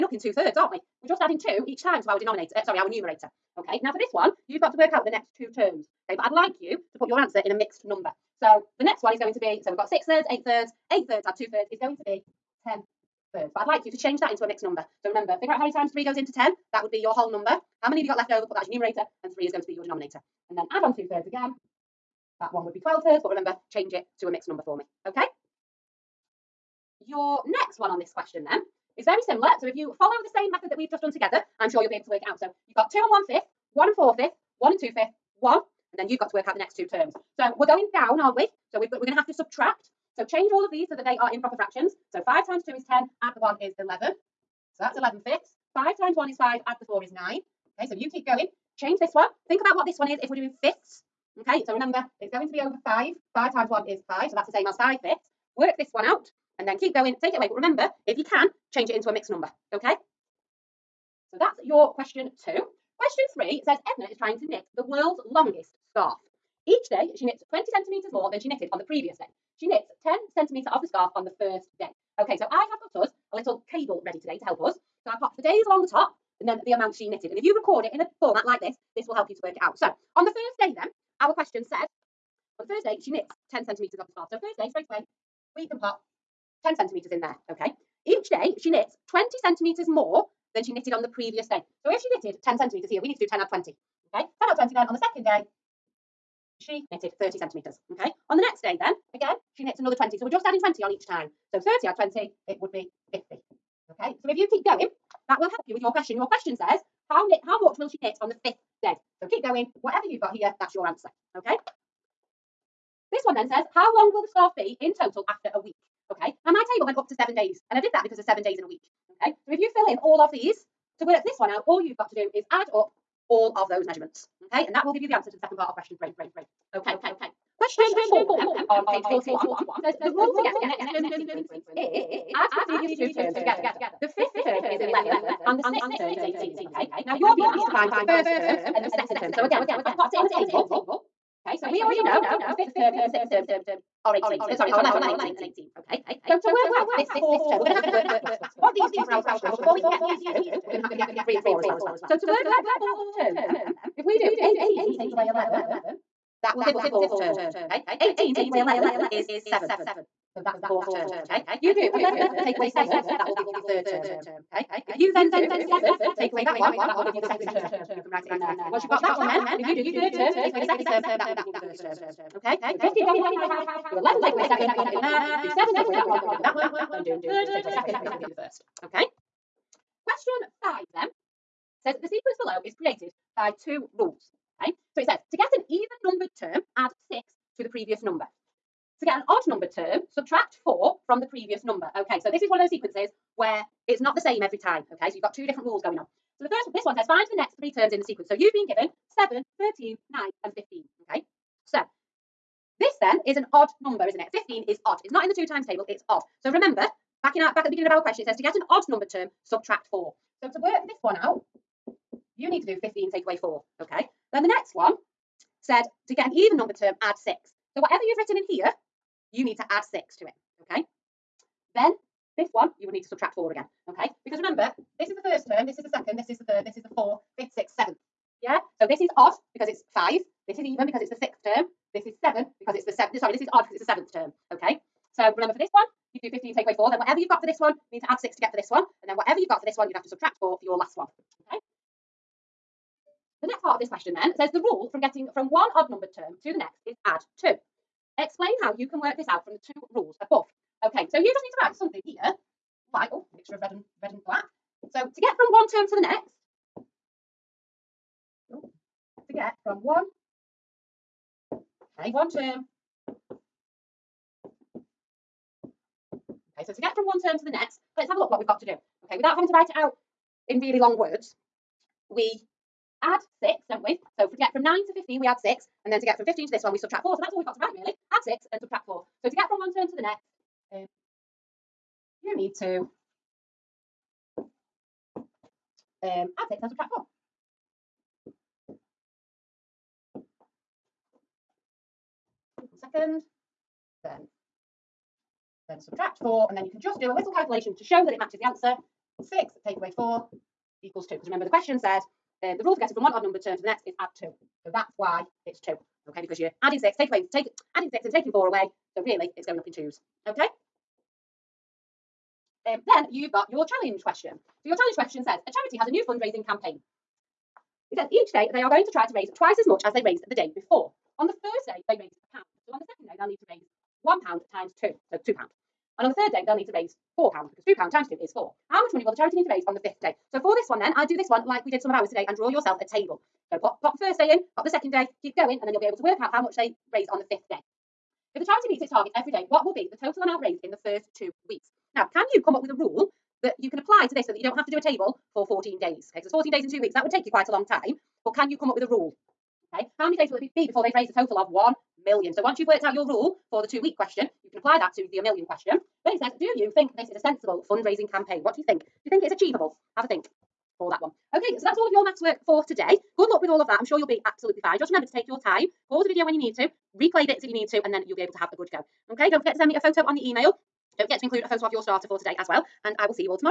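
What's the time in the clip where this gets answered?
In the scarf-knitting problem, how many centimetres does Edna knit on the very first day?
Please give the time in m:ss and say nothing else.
1:10.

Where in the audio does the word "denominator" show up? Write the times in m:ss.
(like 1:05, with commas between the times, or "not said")
0:02, 0:19.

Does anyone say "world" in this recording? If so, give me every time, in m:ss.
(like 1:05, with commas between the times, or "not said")
1:04.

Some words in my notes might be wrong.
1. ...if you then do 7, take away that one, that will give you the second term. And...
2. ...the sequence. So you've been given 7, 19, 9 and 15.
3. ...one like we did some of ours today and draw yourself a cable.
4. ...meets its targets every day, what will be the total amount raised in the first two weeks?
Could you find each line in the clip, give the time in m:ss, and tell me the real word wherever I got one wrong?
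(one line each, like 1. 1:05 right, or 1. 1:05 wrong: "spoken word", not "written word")
1. 2:44 right
2. 3:18 wrong: "13", not "19"
3. 5:31 wrong: "table", not "cable"
4. 5:38 right.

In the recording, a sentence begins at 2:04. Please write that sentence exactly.
Okay, and that will give you the answer to the second part of question three.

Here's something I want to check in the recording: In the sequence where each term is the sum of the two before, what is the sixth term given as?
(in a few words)
18.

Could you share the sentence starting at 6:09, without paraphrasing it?
Okay, don't forget to send me a photo on the email.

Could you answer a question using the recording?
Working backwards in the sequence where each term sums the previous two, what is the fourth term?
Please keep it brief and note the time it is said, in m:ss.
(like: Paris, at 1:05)
7, at 2:38.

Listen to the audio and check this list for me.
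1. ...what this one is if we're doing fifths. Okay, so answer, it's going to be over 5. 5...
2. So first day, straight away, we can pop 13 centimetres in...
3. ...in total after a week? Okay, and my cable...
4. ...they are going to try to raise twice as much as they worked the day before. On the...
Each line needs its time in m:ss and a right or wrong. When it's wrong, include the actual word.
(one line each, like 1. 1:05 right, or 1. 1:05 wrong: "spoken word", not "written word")
1. 0:49 wrong: "remember", not "answer"
2. 1:24 wrong: "10", not "13"
3. 1:54 wrong: "table", not "cable"
4. 5:18 wrong: "raised", not "worked".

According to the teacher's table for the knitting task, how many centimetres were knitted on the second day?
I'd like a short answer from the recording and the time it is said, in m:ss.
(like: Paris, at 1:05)
30 centimetres, at 1:37.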